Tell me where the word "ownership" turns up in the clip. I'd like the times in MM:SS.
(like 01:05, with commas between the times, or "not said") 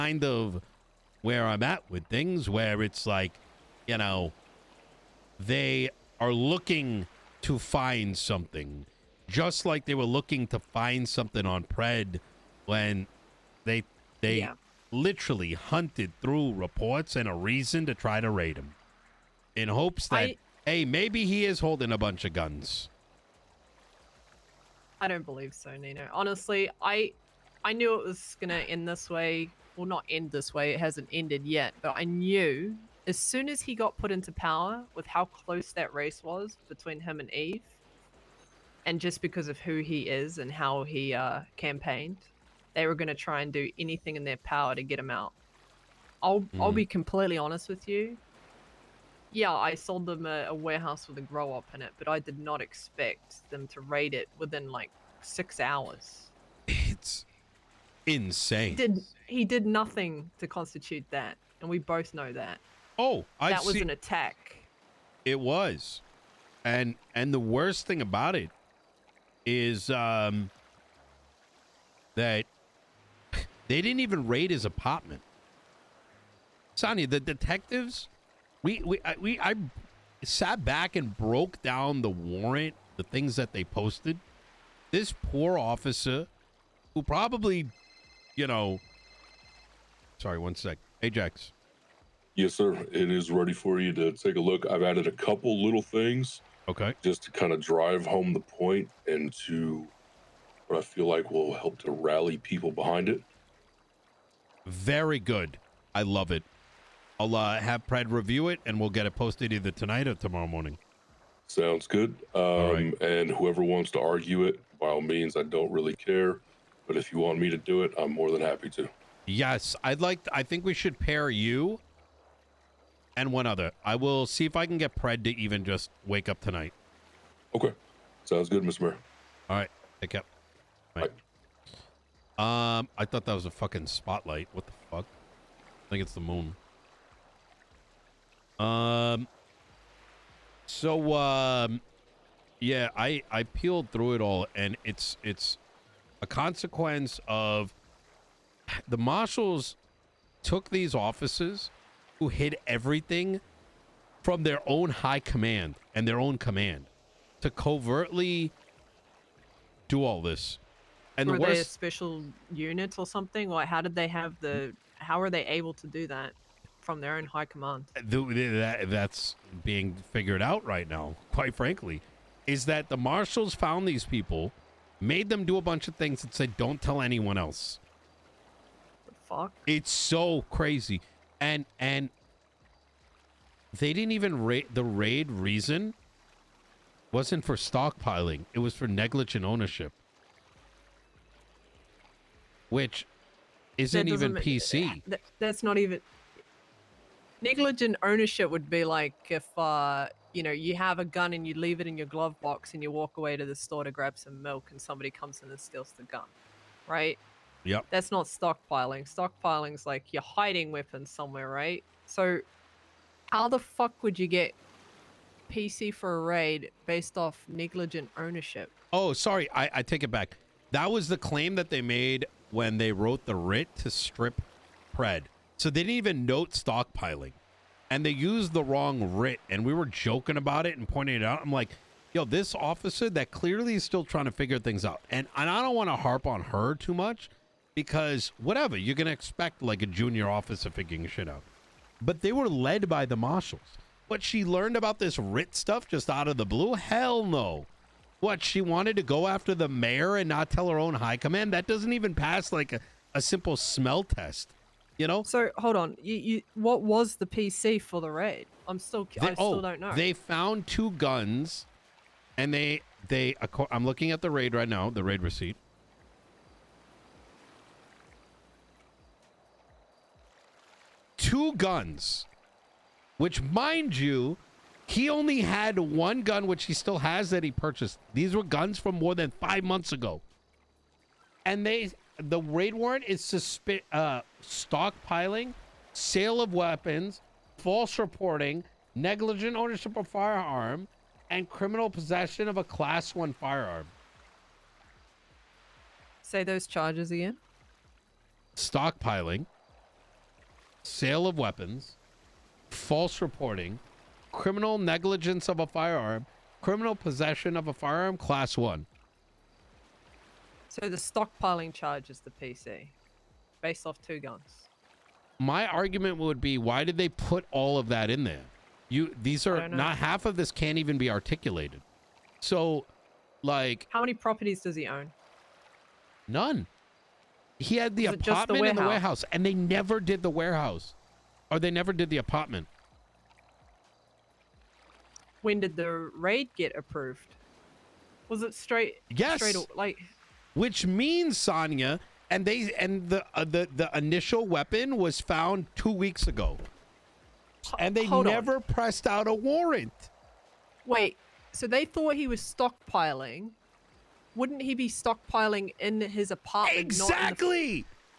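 03:09, 03:18, 03:38, 04:49.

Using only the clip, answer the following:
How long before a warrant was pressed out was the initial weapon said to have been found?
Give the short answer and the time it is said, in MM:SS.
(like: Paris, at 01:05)
2 weeks ago, at 05:45.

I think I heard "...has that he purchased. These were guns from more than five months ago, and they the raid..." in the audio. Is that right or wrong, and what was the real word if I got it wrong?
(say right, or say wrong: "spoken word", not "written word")
right.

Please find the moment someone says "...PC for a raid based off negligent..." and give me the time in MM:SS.
03:35.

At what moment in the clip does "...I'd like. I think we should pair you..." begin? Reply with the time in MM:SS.
01:59.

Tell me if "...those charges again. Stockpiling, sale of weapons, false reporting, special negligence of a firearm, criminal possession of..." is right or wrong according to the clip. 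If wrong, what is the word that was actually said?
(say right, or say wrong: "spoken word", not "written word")
wrong: "criminal", not "special".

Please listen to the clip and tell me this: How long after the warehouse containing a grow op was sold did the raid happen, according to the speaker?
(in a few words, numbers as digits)
6 hours.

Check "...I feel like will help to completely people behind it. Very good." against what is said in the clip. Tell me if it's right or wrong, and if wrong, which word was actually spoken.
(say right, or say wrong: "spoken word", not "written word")
wrong: "rally", not "completely".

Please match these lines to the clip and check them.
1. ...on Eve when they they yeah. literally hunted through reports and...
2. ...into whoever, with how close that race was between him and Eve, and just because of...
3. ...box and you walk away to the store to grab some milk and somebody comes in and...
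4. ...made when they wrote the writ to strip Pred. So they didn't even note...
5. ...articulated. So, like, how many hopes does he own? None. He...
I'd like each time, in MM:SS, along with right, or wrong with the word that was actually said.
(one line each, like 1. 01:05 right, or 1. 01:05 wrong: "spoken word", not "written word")
1. 00:11 wrong: "Pred", not "Eve"
2. 00:34 wrong: "power", not "whoever"
3. 03:22 right
4. 03:41 right
5. 05:21 wrong: "properties", not "hopes".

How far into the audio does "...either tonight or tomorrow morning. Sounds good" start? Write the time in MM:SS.
01:49.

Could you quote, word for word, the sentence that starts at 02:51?
Quite frankly, is that the marshals found these people made them do a bunch of things and said, don't tell anyone else.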